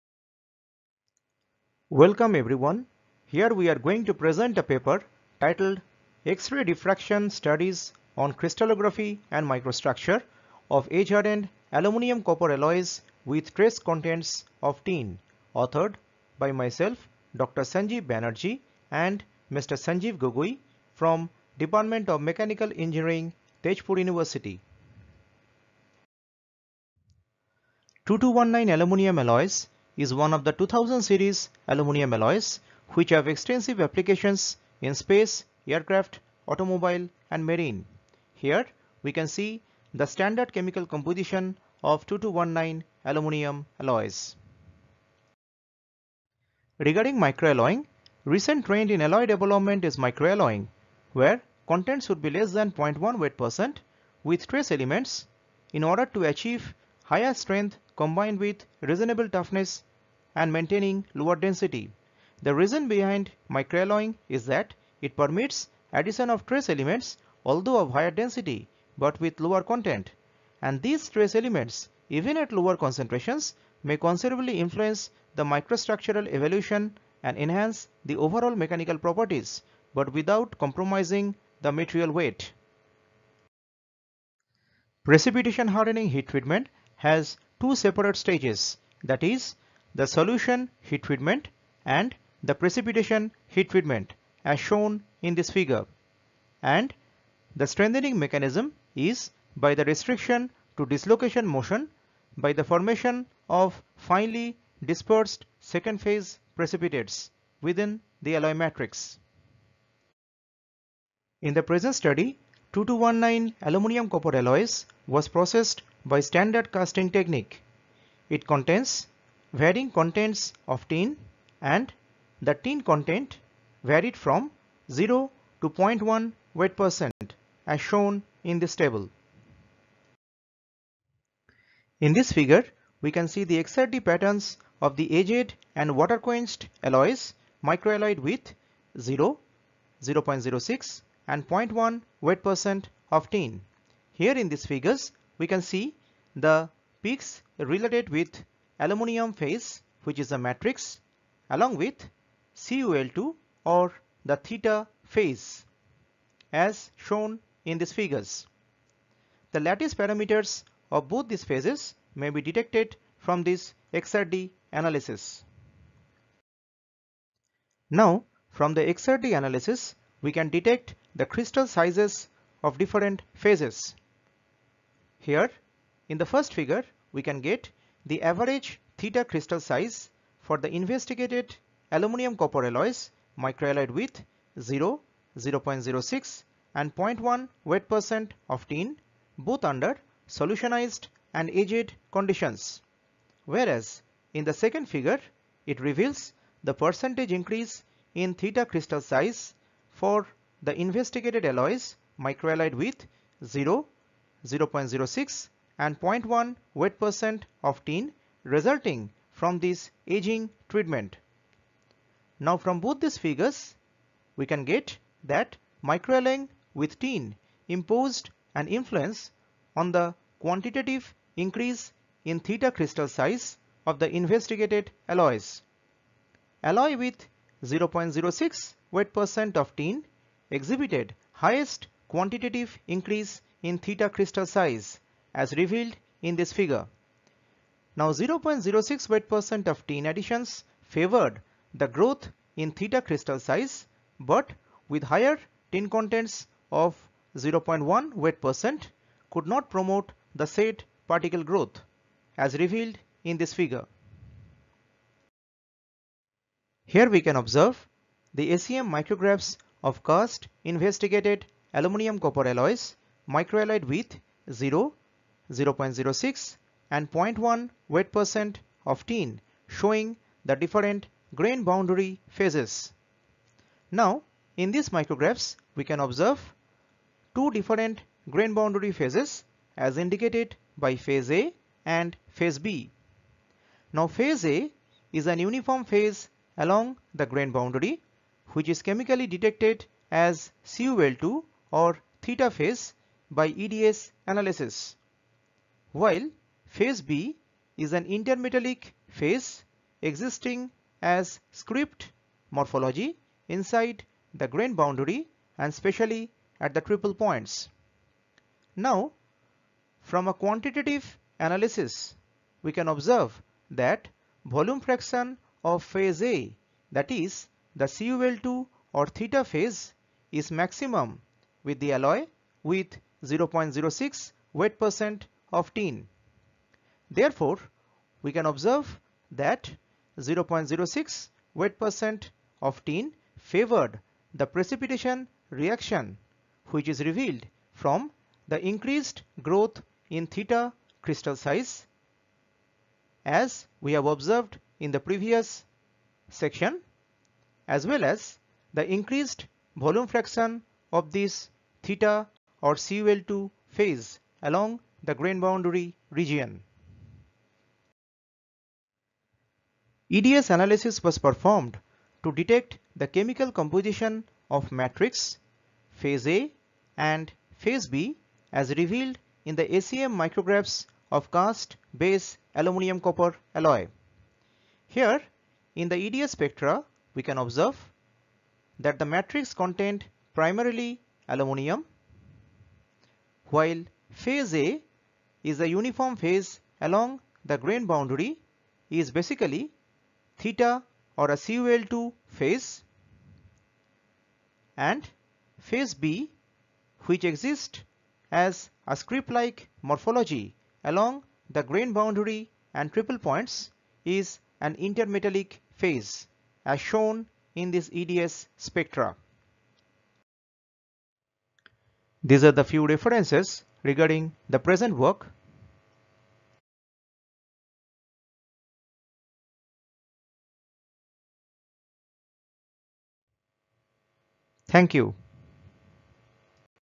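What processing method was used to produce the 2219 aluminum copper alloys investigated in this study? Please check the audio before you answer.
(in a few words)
standard casting technique.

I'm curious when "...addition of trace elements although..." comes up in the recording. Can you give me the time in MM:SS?
01:05.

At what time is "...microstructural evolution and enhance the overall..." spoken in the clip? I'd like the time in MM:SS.
01:15.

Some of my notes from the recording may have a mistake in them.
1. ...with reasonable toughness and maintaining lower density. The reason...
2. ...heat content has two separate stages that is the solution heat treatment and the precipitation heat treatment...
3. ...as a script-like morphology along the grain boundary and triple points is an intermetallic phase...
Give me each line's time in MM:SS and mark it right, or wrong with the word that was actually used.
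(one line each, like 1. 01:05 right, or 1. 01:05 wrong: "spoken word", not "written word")
1. 00:58 right
2. 01:26 wrong: "treatment", not "content"
3. 06:38 right.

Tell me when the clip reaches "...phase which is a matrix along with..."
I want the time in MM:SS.
02:29.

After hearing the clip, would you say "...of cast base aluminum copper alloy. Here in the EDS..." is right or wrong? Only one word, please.
right.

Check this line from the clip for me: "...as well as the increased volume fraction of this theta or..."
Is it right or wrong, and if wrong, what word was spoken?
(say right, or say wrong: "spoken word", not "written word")
right.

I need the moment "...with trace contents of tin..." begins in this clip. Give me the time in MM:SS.
00:13.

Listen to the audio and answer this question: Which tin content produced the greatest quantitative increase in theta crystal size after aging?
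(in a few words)
0.06 wt%.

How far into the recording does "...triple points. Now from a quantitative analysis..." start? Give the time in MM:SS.
05:06.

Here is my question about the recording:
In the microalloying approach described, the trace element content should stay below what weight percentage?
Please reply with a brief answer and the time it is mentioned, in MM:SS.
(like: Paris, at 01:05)
0.1 weight percent, at 00:52.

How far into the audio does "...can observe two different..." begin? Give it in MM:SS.
04:35.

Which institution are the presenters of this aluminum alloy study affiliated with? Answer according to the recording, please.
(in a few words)
Tezpur University.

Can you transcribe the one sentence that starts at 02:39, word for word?
The lattice parameters of both these phases may be detected from this XRD analysis.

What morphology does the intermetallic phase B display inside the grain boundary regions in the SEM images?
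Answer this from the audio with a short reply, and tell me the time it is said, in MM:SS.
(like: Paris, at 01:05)
script morphology, at 05:01.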